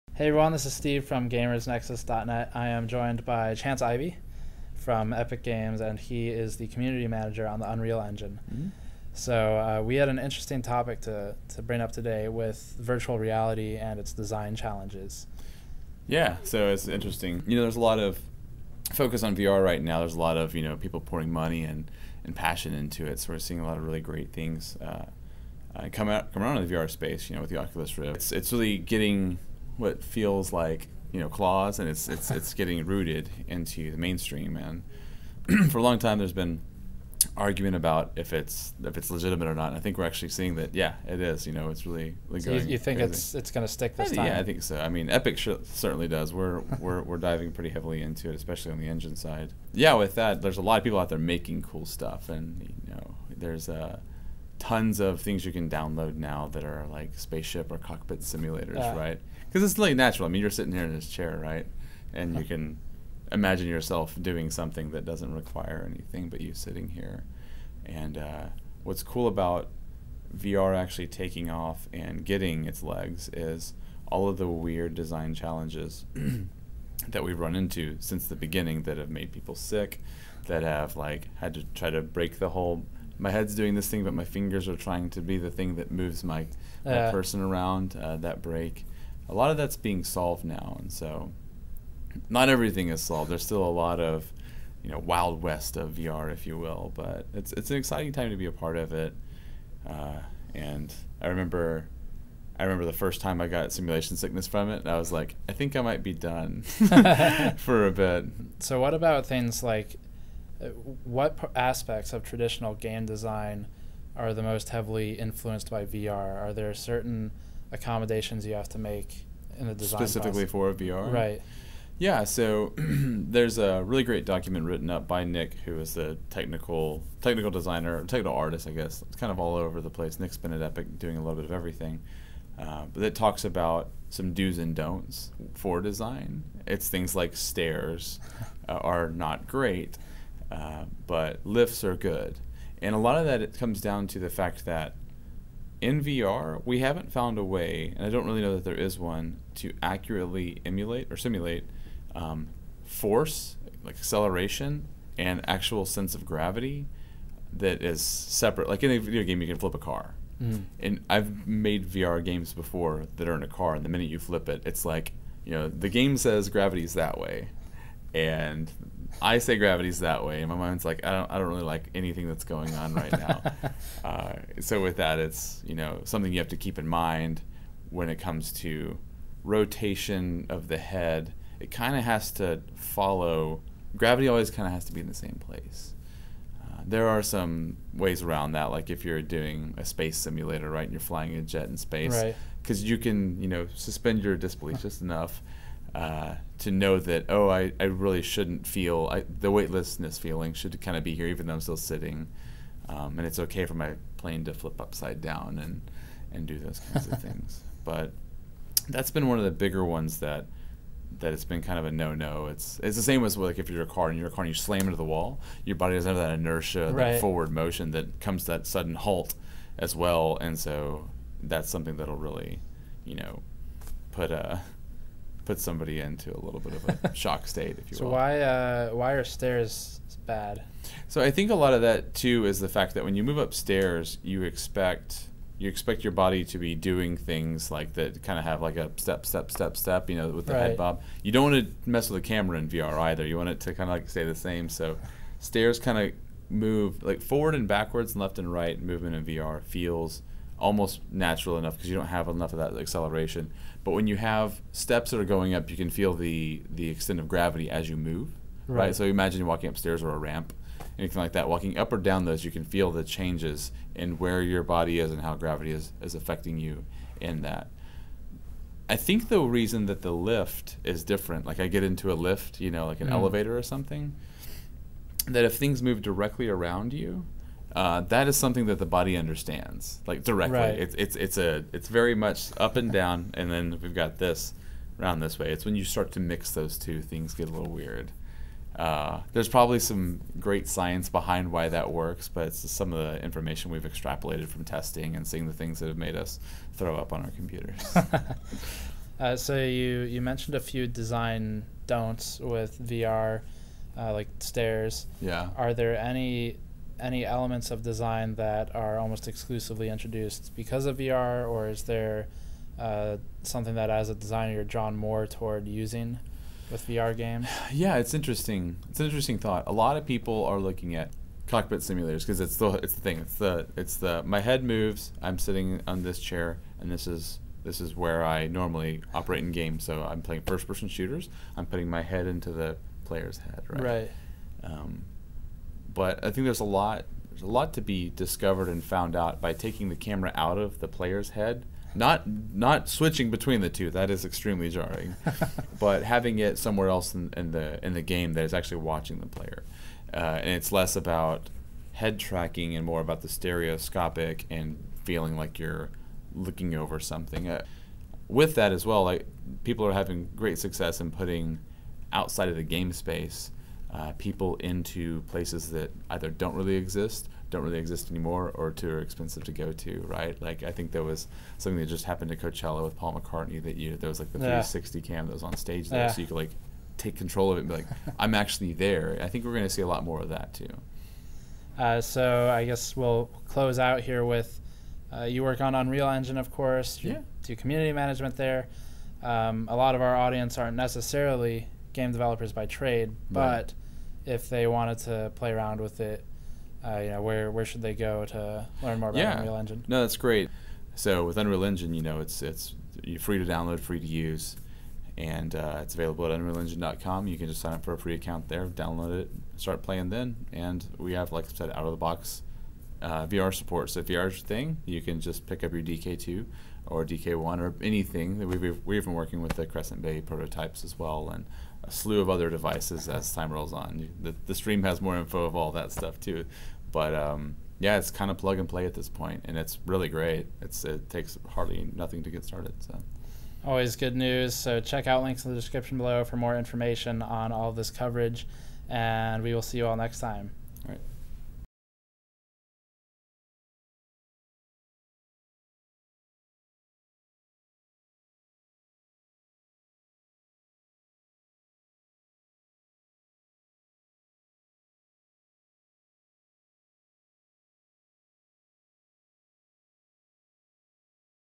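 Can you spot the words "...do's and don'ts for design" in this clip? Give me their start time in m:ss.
2:14.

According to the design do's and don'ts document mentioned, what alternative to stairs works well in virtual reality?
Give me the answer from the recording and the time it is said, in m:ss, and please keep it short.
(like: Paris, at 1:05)
Lifts, at 2:21.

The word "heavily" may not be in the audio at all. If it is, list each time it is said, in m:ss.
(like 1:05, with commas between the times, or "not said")
0:47, 1:54.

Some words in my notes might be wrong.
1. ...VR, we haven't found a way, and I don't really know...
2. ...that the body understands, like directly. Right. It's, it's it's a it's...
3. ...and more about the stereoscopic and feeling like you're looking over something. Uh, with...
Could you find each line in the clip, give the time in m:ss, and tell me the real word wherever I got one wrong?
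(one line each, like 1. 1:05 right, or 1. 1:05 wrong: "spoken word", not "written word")
1. 2:26 right
2. 4:38 right
3. 5:52 right.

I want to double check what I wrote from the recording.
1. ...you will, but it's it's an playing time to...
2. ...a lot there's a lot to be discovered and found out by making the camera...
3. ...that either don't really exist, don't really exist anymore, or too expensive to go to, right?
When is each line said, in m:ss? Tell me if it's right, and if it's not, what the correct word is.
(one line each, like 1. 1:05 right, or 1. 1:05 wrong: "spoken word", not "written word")
1. 1:36 wrong: "exciting", not "playing"
2. 5:36 wrong: "taking", not "making"
3. 6:05 right.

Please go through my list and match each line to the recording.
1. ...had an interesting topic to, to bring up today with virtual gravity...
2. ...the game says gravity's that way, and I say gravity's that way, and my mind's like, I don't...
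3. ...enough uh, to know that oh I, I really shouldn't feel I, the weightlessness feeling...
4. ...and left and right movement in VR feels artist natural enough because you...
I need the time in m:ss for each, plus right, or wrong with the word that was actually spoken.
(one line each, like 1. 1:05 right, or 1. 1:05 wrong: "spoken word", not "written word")
1. 0:09 wrong: "reality", not "gravity"
2. 2:45 right
3. 3:15 right
4. 4:08 wrong: "almost", not "artist".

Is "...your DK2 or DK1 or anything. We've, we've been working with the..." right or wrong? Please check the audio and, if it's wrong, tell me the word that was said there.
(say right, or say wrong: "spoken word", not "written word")
right.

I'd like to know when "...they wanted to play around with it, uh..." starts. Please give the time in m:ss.
6:34.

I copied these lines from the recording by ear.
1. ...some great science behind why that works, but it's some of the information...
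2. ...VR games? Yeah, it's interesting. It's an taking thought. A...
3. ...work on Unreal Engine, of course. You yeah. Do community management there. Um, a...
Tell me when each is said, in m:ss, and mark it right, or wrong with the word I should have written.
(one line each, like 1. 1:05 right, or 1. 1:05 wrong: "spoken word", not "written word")
1. 4:49 right
2. 5:16 wrong: "interesting", not "taking"
3. 6:25 right.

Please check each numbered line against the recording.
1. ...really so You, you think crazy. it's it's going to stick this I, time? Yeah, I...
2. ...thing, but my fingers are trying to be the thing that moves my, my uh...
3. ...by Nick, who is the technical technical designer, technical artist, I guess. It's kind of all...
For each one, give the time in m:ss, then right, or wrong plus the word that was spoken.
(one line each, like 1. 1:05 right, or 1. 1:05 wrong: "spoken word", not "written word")
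1. 0:42 right
2. 1:23 right
3. 2:05 right.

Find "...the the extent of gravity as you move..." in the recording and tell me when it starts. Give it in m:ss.
4:16.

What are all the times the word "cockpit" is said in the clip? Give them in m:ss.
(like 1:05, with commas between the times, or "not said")
0:57, 5:21.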